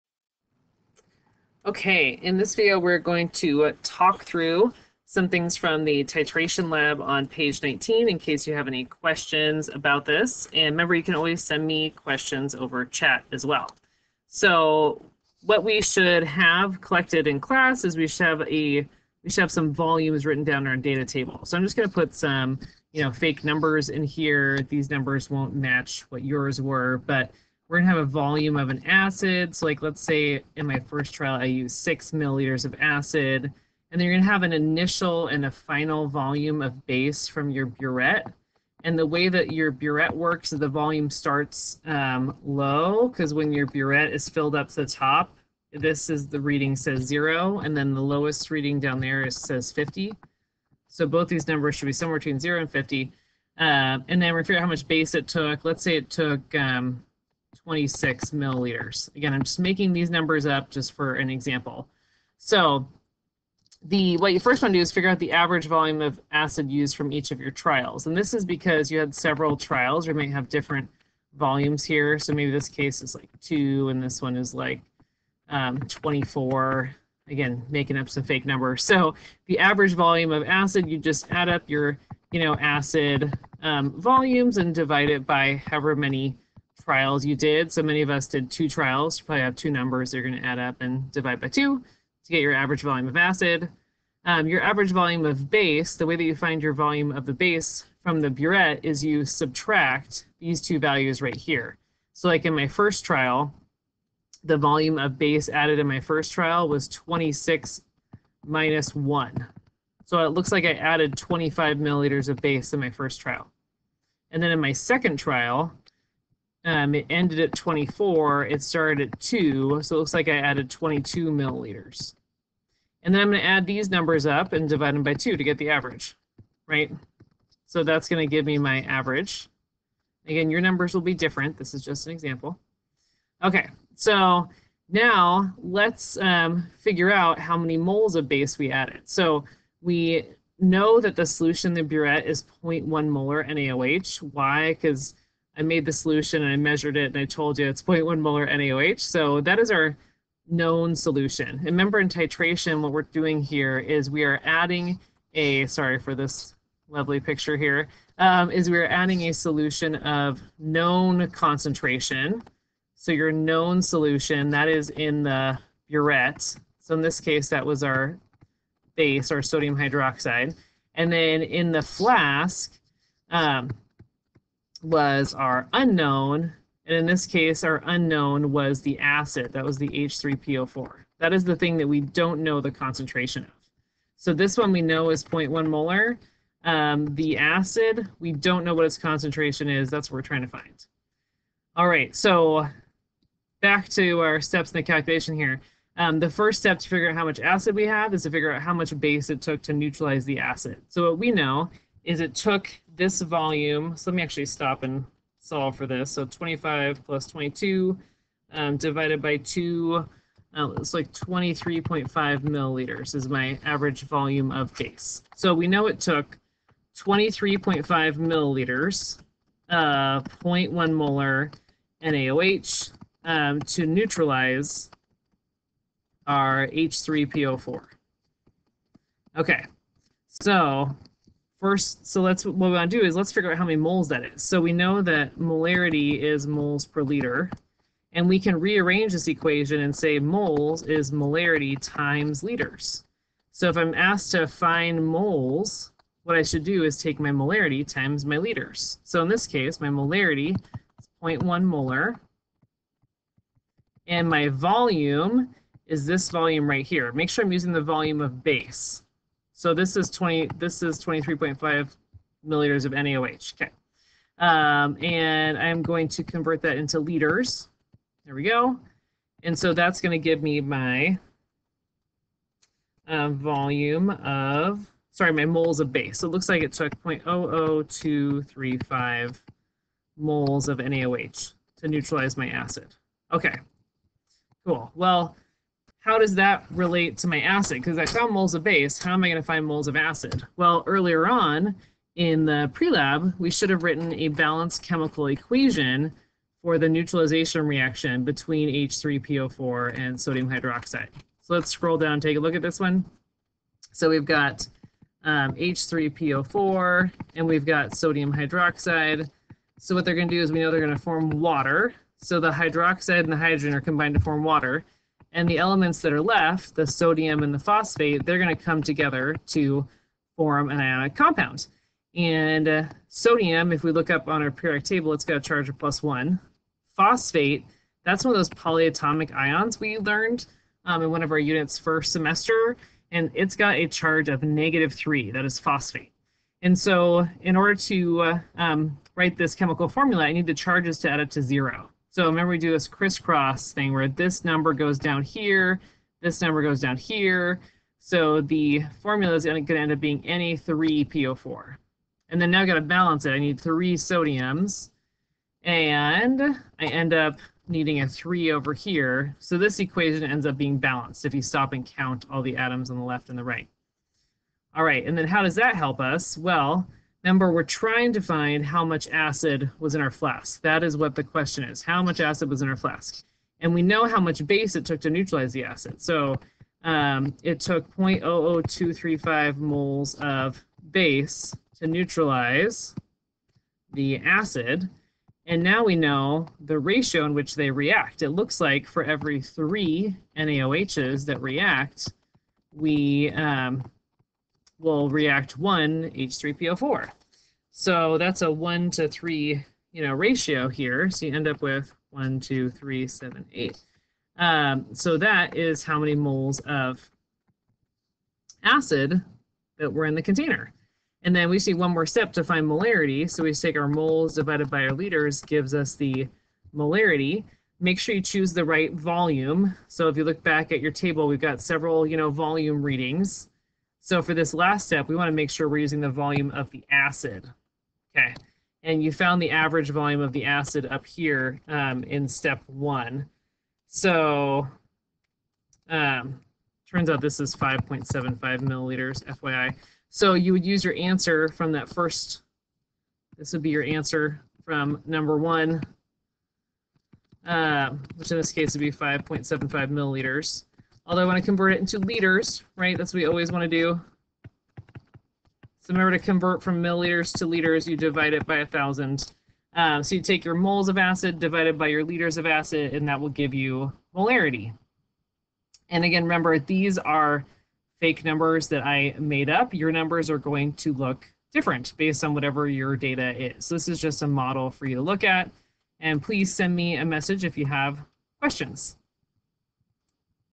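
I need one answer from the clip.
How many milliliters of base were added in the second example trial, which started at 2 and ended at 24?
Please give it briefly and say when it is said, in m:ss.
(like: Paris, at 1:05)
22 milliliters, at 2:00.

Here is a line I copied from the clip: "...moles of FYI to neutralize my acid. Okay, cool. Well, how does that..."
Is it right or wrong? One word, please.
wrong.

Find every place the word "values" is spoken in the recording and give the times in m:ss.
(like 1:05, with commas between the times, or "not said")
1:40.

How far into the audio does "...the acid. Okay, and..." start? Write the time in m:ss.
7:06.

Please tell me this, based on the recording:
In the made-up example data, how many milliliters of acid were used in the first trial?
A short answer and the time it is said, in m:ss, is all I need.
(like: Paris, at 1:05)
6 milliliters, at 0:31.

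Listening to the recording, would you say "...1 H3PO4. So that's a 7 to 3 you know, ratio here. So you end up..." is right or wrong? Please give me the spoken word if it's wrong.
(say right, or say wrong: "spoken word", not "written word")
wrong: "1", not "7".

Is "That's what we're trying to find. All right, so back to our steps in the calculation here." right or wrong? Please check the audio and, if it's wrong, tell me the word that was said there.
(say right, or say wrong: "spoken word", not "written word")
right.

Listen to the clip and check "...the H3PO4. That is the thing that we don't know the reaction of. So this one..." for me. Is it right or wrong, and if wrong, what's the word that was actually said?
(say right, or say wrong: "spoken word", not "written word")
wrong: "concentration", not "reaction".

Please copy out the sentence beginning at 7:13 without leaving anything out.
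So um, turns out this is 5.75 milliliters, FYI.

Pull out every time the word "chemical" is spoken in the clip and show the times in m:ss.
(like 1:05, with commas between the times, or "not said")
4:54, 5:39.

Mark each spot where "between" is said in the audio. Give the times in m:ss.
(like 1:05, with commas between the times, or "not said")
0:52, 4:58.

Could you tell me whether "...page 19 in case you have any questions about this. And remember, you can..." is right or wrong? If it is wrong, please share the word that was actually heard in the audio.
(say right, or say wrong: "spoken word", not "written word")
right.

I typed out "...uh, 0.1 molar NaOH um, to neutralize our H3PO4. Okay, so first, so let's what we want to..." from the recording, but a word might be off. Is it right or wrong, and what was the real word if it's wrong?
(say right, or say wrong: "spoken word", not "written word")
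right.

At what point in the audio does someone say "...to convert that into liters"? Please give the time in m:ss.
4:26.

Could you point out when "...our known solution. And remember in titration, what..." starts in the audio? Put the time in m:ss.
2:29.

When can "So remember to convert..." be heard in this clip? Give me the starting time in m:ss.
7:35.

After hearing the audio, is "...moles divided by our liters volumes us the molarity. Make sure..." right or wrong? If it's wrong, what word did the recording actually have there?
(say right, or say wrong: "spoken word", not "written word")
wrong: "gives", not "volumes".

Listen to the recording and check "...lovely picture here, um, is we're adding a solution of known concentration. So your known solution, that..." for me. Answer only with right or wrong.
right.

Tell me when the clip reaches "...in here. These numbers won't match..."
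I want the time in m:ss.
0:23.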